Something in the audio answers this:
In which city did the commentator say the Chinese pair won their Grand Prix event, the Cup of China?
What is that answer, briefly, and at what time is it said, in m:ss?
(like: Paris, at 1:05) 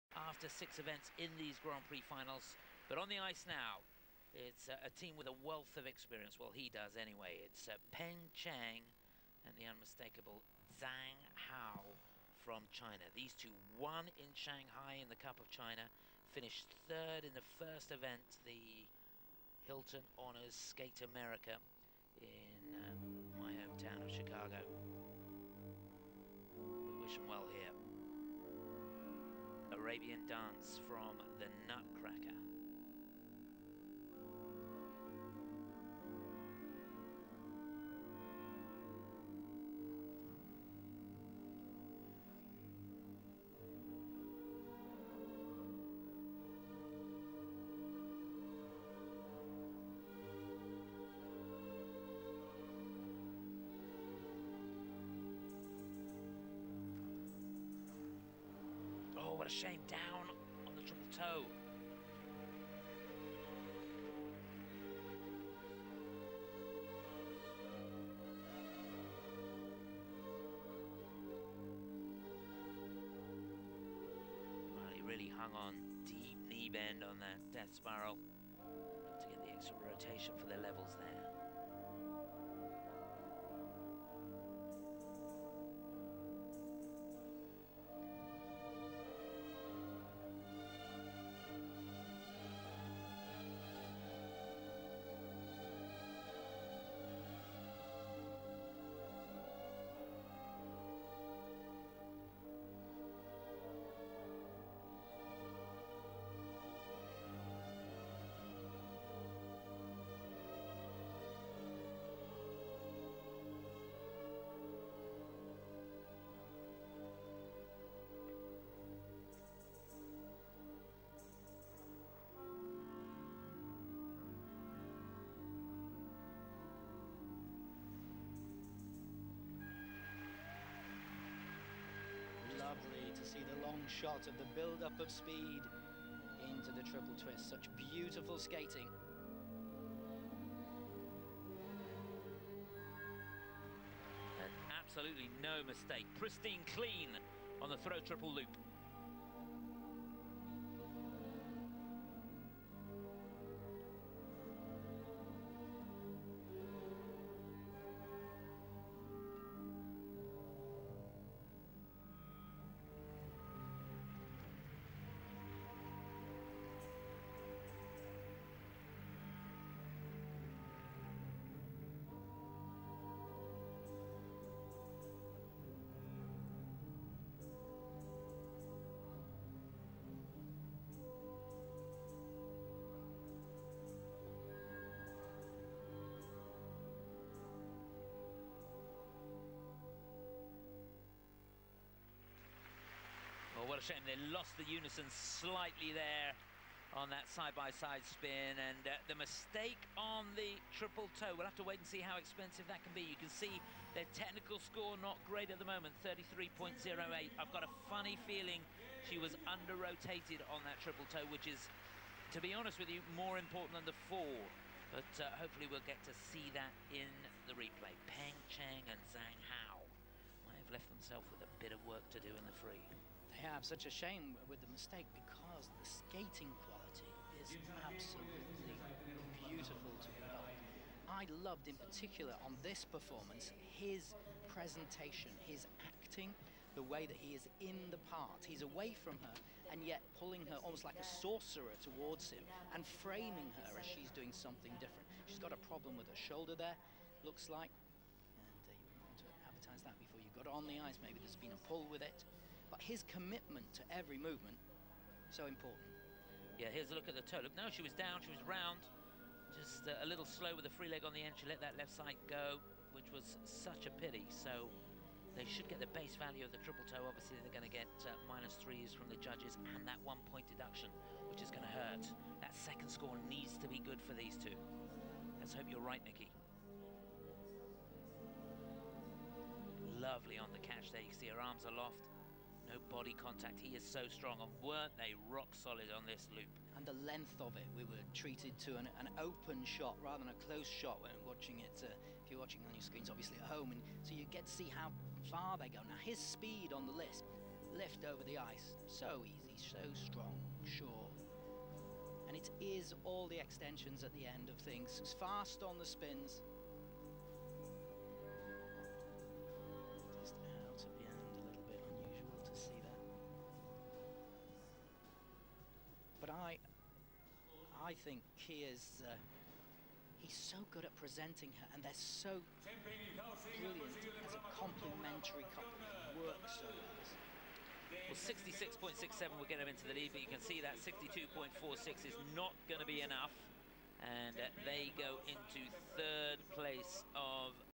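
Shanghai, at 0:14.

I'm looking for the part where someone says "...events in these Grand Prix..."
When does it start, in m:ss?
0:00.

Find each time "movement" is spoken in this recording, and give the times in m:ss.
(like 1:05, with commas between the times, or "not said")
4:14.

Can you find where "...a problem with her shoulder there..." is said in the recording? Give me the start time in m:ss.
4:05.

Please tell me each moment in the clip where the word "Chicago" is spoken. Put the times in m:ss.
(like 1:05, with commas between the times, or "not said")
0:24.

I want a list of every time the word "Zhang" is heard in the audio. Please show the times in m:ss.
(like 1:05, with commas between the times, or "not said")
0:10, 3:39.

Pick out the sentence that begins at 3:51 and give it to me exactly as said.
I loved in particular on this performance his presentation, his acting, the way that he is in the part.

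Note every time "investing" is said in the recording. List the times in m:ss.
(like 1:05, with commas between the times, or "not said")
not said.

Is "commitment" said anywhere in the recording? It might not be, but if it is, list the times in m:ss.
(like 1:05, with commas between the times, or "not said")
4:13.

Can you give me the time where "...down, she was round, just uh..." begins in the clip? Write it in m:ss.
4:17.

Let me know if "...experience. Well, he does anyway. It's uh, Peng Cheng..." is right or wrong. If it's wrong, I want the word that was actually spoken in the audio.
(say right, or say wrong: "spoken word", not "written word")
right.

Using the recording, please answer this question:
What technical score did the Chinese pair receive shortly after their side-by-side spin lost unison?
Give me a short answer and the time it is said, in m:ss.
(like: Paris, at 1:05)
33.08, at 3:26.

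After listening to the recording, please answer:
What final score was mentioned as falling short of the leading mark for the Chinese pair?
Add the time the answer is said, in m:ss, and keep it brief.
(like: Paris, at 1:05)
62.46, at 5:30.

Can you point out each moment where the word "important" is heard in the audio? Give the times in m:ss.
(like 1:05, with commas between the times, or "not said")
3:33, 4:15.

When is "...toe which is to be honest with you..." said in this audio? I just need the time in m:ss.
3:31.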